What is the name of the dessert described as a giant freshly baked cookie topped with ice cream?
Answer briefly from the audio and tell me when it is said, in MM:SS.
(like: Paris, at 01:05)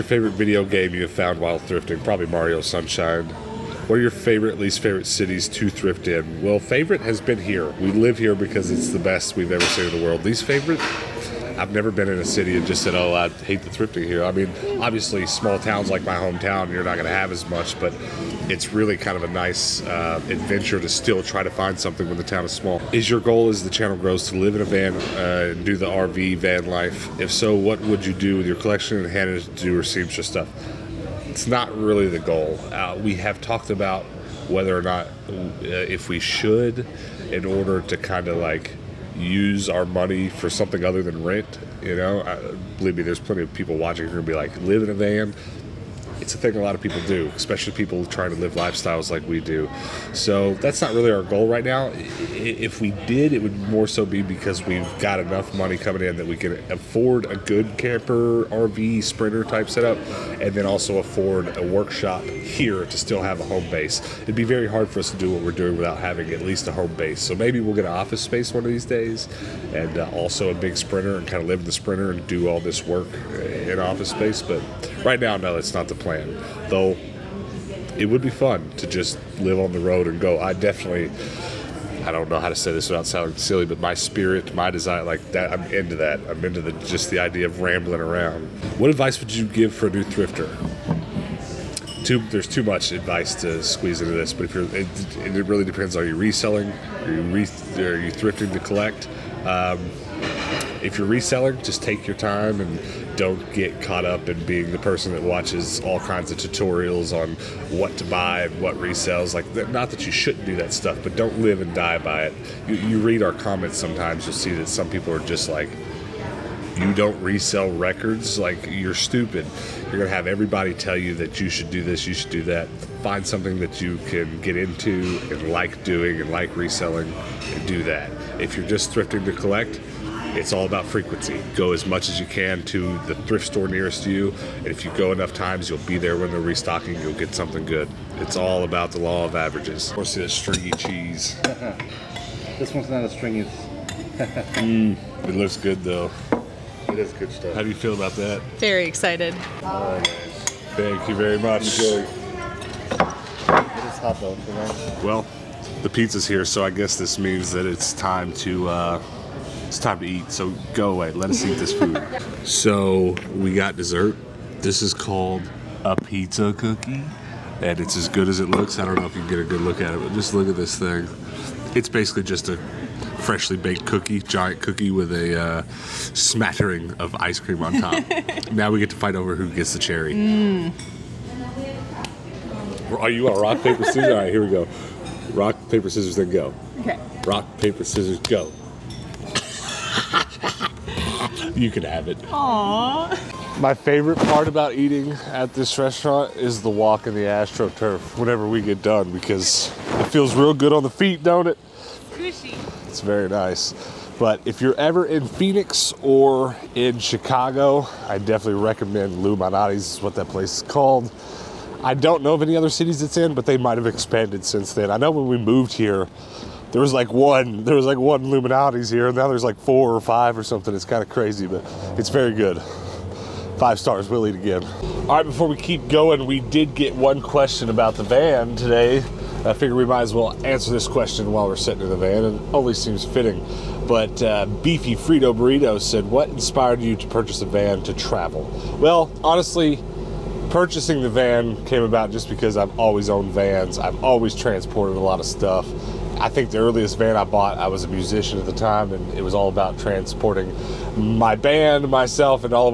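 Pizza cookie, at 02:45.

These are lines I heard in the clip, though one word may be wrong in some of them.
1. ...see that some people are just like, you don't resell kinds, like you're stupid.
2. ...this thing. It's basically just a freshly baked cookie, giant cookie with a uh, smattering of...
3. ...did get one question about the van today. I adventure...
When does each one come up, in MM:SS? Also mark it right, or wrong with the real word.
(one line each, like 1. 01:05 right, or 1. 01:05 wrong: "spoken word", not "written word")
1. 01:54 wrong: "records", not "kinds"
2. 02:50 right
3. 03:46 wrong: "figure", not "adventure".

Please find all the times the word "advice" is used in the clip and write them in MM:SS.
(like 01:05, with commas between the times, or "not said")
01:28, 01:32.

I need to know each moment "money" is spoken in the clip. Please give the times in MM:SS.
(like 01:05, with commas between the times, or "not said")
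00:39, 00:55.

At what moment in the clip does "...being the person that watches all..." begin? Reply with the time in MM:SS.
01:44.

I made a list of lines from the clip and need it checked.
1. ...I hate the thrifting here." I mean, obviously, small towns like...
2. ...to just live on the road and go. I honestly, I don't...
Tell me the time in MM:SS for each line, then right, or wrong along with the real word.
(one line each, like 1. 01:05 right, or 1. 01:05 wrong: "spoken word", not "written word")
1. 00:13 right
2. 01:18 wrong: "definitely", not "honestly".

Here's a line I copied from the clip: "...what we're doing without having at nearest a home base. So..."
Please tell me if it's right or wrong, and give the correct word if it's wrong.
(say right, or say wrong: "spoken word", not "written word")
wrong: "least", not "nearest".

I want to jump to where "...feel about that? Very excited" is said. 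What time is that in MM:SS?
02:27.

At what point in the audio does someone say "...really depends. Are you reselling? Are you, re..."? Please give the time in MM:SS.
01:35.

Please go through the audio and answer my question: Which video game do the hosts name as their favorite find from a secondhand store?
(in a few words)
Mario Sunshine.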